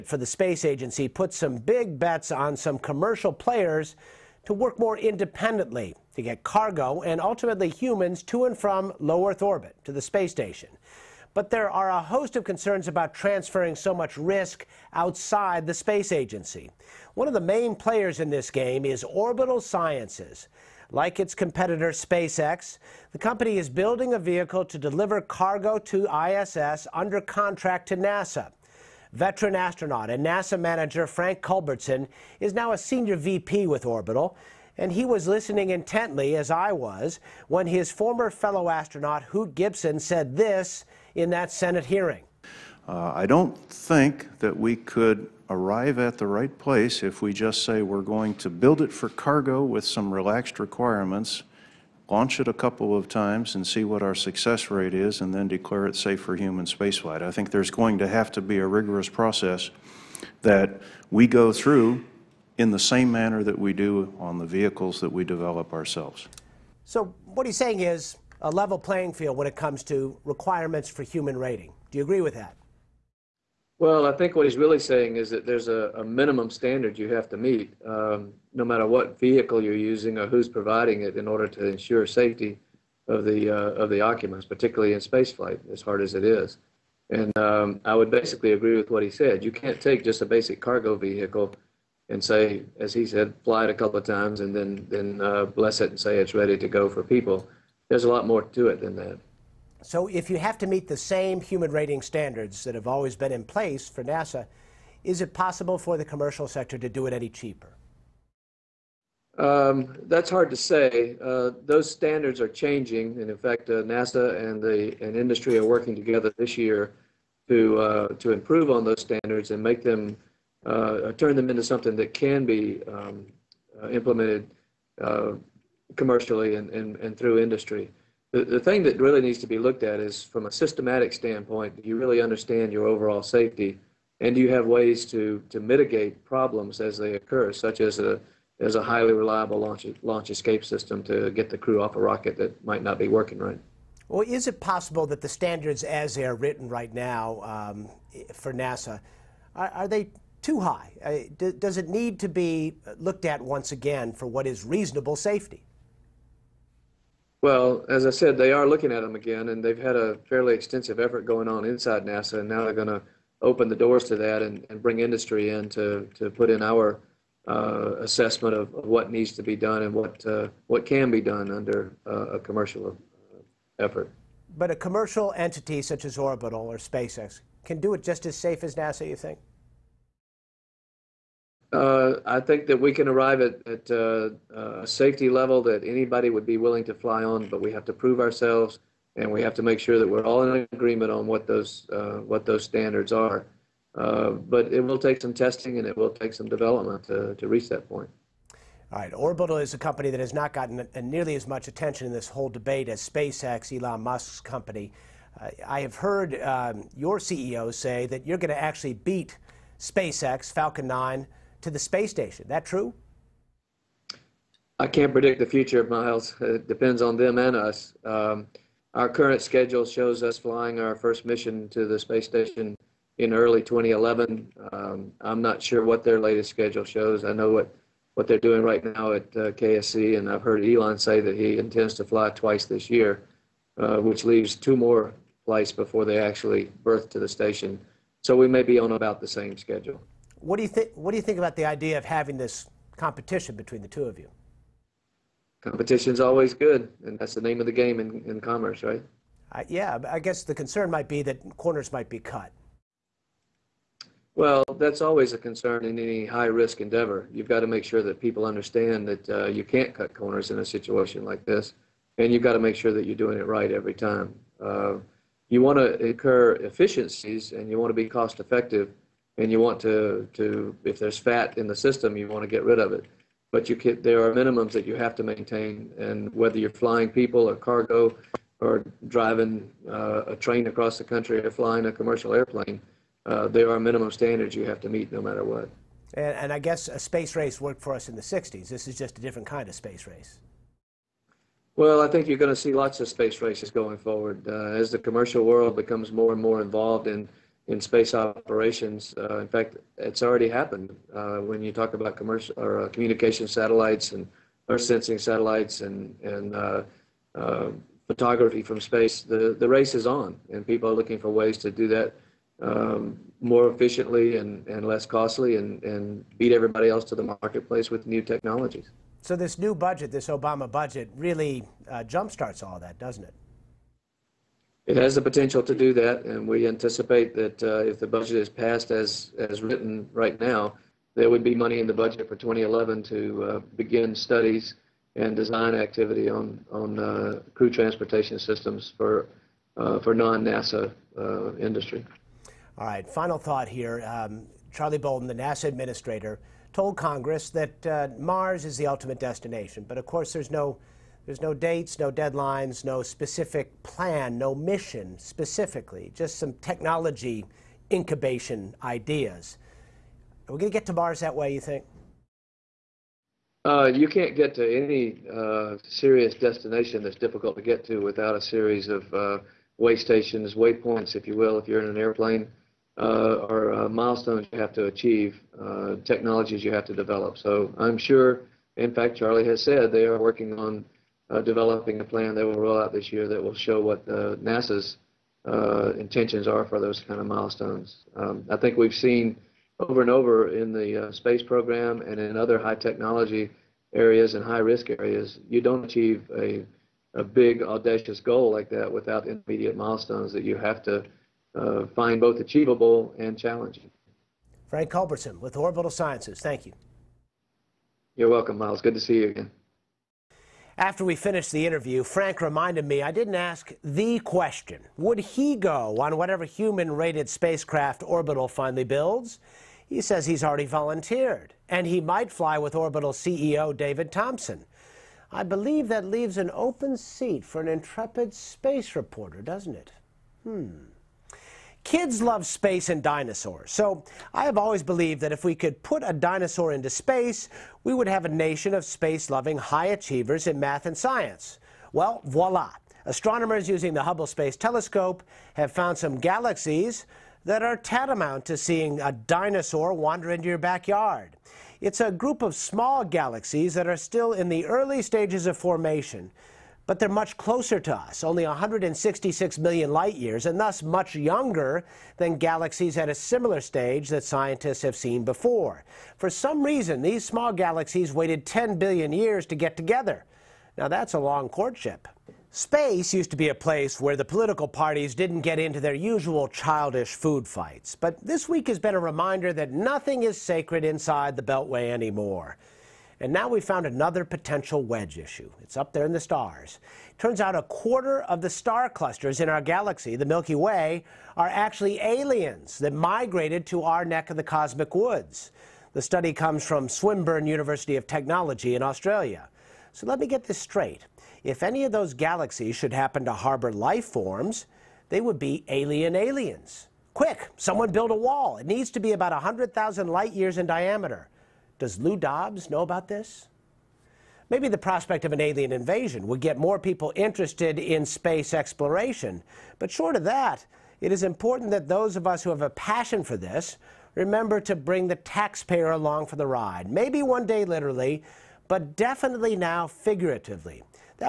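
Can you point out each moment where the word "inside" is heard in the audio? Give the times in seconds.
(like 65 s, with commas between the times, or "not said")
161 s, 480 s.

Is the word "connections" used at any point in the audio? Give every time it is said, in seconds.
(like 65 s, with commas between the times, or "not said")
not said.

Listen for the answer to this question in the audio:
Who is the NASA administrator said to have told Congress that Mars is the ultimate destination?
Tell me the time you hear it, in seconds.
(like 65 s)
344 s.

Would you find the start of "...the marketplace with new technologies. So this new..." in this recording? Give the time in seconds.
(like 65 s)
317 s.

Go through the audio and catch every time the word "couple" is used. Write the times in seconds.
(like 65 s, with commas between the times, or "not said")
52 s, 93 s.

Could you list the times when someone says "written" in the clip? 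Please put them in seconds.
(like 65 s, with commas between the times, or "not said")
146 s, 329 s.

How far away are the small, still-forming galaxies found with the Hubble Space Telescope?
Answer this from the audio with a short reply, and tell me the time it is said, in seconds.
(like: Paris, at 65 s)
166 million light years, at 458 s.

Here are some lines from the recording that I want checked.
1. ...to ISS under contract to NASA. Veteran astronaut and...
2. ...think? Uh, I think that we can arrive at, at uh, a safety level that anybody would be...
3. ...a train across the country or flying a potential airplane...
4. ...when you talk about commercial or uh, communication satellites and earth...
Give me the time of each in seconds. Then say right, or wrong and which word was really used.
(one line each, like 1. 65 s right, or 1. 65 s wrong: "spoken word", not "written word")
1. 25 s right
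2. 179 s right
3. 280 s wrong: "commercial", not "potential"
4. 301 s right.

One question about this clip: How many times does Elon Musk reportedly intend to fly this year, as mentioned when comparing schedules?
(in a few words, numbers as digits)
2.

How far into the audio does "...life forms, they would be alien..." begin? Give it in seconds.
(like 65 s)
503 s.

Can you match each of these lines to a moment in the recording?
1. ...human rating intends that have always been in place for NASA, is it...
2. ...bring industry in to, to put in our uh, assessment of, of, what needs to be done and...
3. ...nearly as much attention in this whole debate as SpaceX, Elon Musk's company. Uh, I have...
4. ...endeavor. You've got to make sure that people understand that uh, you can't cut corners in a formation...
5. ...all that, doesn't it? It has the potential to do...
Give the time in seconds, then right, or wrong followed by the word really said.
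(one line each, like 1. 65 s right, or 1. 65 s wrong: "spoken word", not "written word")
1. 101 s wrong: "standards", not "intends"
2. 164 s right
3. 201 s right
4. 256 s wrong: "situation", not "formation"
5. 322 s right.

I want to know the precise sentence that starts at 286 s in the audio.
And, and, I guess a space race worked for us in the 60s.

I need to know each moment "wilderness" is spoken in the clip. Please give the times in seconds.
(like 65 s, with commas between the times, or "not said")
not said.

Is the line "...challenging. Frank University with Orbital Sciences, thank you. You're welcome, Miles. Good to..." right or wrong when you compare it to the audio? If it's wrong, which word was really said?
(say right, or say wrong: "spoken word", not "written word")
wrong: "Culbertson", not "University".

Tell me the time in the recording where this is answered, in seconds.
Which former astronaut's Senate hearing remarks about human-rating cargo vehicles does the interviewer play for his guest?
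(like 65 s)
39 s.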